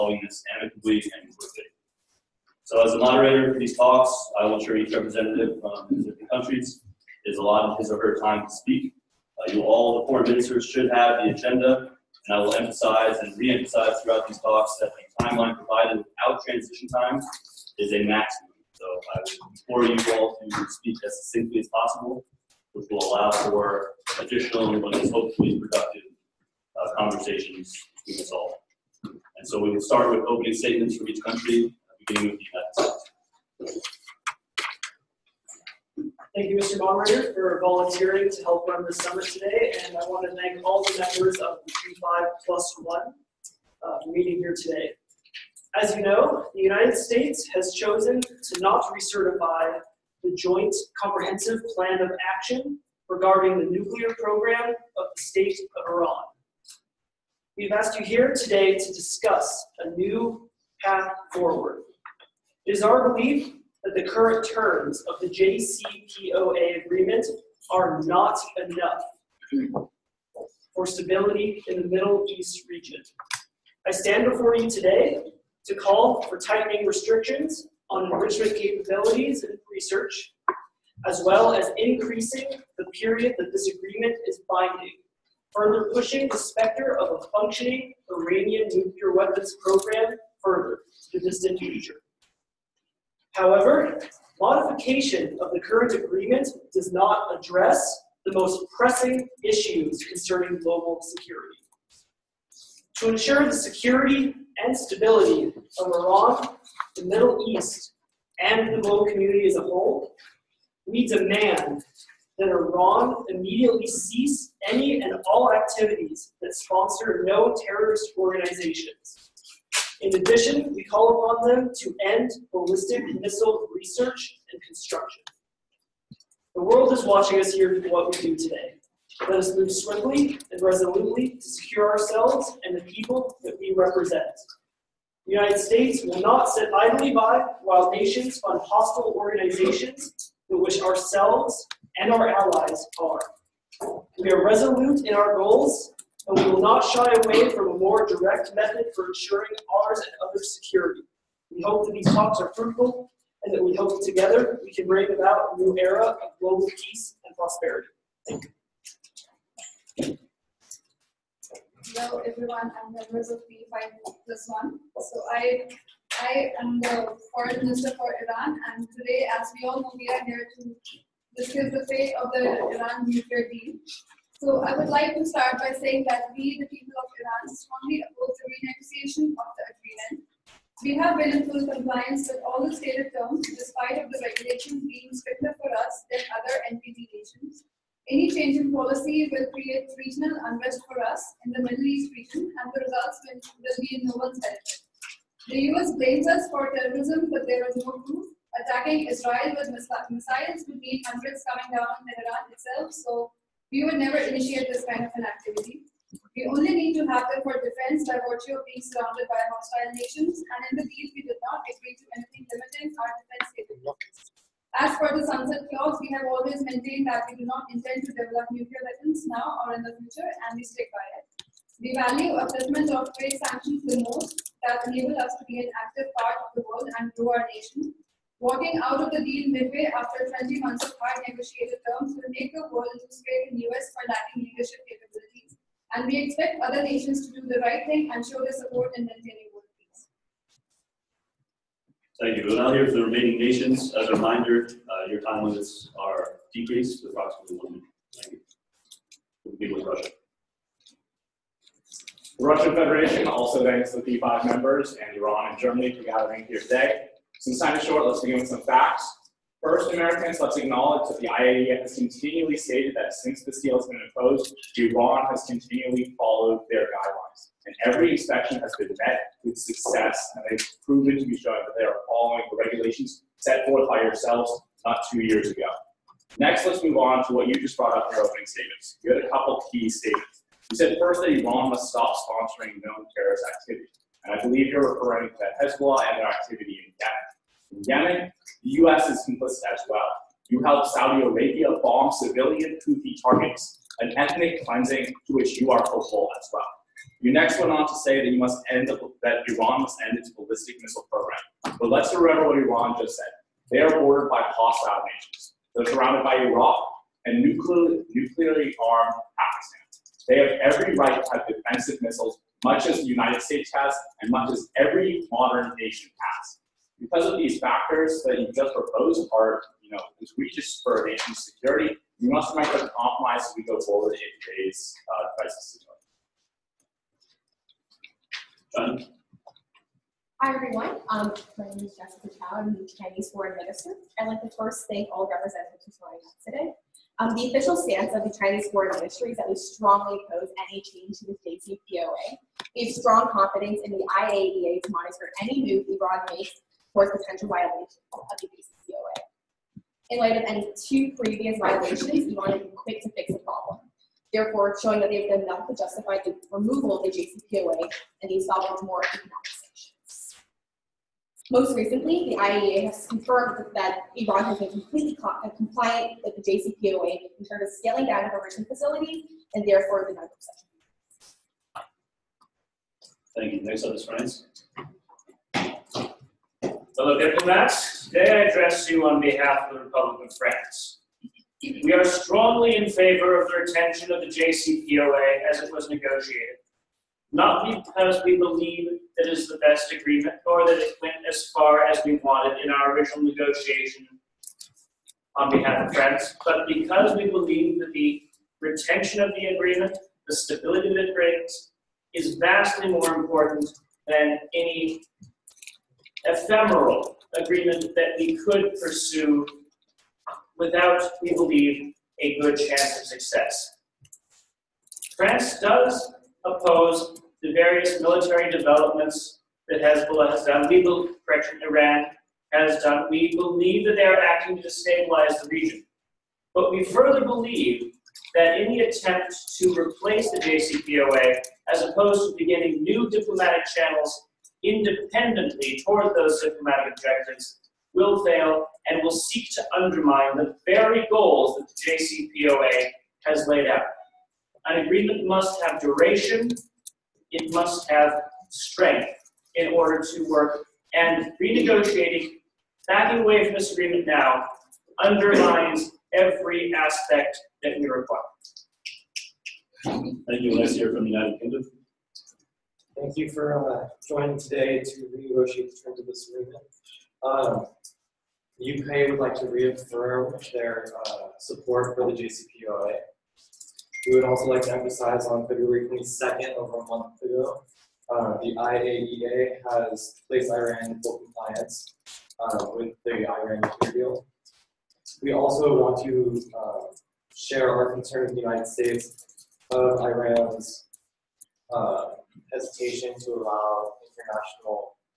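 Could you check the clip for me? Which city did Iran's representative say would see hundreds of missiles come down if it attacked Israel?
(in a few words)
Tehran.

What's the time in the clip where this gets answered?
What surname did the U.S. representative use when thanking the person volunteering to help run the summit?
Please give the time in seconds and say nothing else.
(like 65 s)
36 s.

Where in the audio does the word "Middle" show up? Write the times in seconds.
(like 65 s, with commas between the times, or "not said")
71 s, 107 s, 191 s.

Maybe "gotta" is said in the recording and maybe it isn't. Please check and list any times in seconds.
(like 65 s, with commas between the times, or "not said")
not said.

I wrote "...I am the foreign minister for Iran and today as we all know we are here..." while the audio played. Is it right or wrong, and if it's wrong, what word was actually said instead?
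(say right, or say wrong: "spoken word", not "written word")
right.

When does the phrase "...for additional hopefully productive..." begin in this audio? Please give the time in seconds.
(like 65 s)
23 s.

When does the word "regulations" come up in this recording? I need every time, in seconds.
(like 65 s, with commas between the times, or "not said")
184 s, 272 s.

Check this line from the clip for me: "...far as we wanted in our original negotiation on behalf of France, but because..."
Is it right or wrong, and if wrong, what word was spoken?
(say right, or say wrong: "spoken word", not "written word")
right.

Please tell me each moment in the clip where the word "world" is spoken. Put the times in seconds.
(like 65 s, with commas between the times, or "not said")
126 s, 226 s, 232 s.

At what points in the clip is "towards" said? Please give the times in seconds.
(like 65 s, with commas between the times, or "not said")
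346 s, 435 s.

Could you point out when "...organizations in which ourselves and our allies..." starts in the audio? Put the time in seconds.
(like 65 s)
139 s.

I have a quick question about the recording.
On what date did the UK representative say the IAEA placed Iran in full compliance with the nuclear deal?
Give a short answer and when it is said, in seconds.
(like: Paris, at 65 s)
February 22nd, at 475 s.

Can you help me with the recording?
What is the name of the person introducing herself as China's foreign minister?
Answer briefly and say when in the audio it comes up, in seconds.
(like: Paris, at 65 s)
Jessica Chow, at 331 s.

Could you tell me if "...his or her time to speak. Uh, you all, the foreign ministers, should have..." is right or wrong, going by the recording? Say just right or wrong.
right.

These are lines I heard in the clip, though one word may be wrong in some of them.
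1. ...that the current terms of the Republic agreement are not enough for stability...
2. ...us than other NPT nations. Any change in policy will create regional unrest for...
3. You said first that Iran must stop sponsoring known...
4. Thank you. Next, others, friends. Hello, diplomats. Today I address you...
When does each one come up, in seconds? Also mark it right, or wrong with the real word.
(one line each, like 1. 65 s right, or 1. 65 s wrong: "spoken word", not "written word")
1. 63 s wrong: "JCPOA", not "Republic"
2. 185 s right
3. 280 s right
4. 373 s right.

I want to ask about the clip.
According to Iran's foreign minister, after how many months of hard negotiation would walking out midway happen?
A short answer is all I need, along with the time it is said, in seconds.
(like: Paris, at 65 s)
20, at 230 s.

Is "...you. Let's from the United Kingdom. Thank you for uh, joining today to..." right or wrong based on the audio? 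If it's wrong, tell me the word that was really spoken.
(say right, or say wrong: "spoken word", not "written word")
right.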